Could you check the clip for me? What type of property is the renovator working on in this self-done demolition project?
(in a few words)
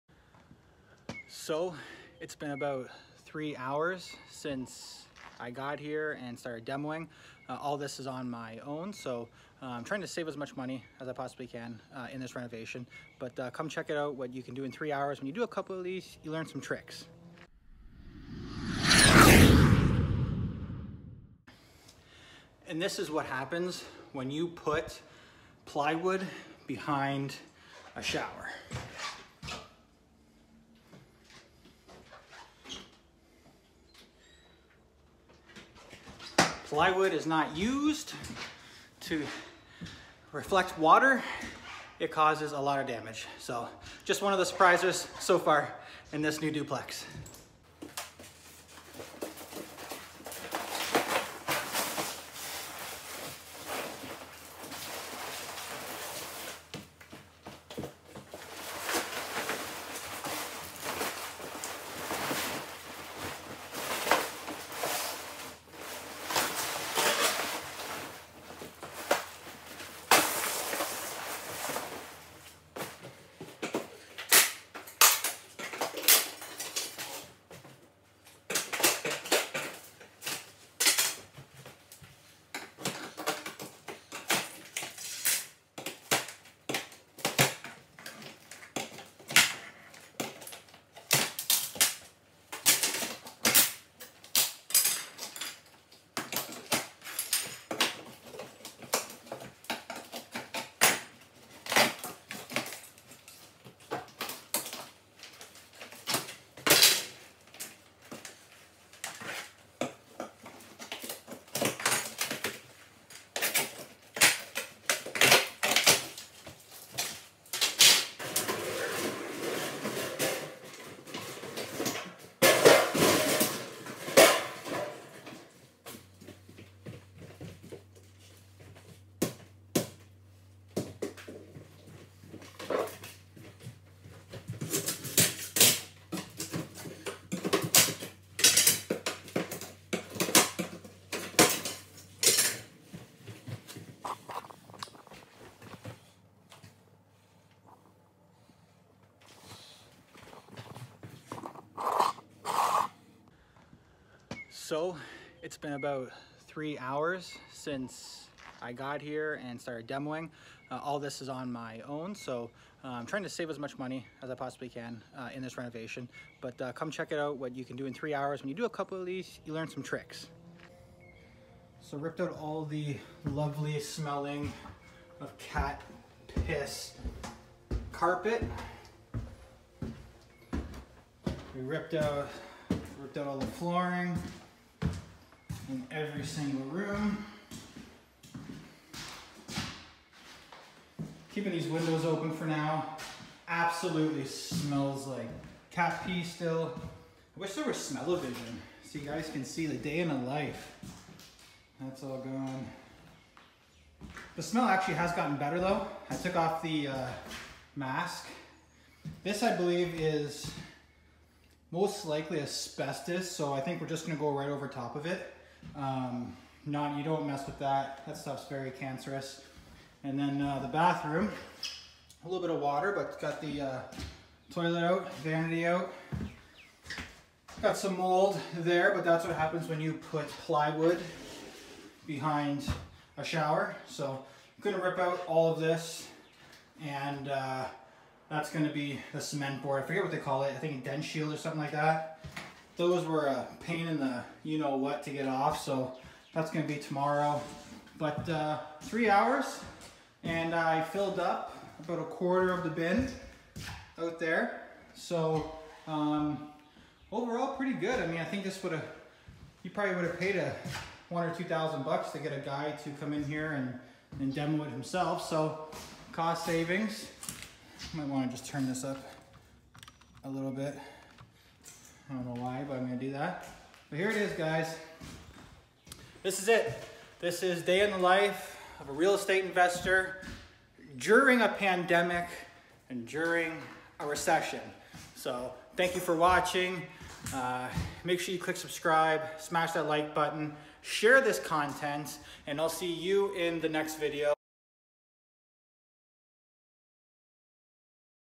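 duplex.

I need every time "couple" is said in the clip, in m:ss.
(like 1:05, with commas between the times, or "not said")
0:15, 2:48.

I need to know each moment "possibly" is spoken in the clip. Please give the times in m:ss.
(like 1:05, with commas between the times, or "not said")
0:11, 2:44.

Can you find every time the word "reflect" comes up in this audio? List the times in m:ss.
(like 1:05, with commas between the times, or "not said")
0:40.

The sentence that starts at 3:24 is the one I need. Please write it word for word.
The smell actually has gotten better though.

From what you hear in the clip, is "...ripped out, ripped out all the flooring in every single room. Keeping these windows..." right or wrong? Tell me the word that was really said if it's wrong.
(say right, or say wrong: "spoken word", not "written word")
right.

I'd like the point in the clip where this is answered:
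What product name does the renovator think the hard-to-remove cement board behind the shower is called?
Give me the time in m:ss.
4:00.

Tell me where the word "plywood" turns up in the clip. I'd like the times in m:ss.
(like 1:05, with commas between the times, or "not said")
0:25, 0:36, 3:50.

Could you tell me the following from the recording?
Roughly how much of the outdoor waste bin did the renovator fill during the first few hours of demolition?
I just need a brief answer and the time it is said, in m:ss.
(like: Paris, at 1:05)
a quarter, at 4:11.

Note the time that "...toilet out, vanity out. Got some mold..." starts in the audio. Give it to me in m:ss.
3:44.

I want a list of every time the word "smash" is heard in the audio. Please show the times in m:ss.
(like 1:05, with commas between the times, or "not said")
4:49.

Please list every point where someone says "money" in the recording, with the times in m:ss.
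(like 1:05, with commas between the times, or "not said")
0:10, 2:43.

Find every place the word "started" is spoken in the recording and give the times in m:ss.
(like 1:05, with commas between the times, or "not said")
0:06, 2:39.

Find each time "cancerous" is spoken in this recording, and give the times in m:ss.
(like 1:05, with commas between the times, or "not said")
3:38.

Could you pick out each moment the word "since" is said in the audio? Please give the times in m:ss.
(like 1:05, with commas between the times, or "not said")
0:04, 2:37.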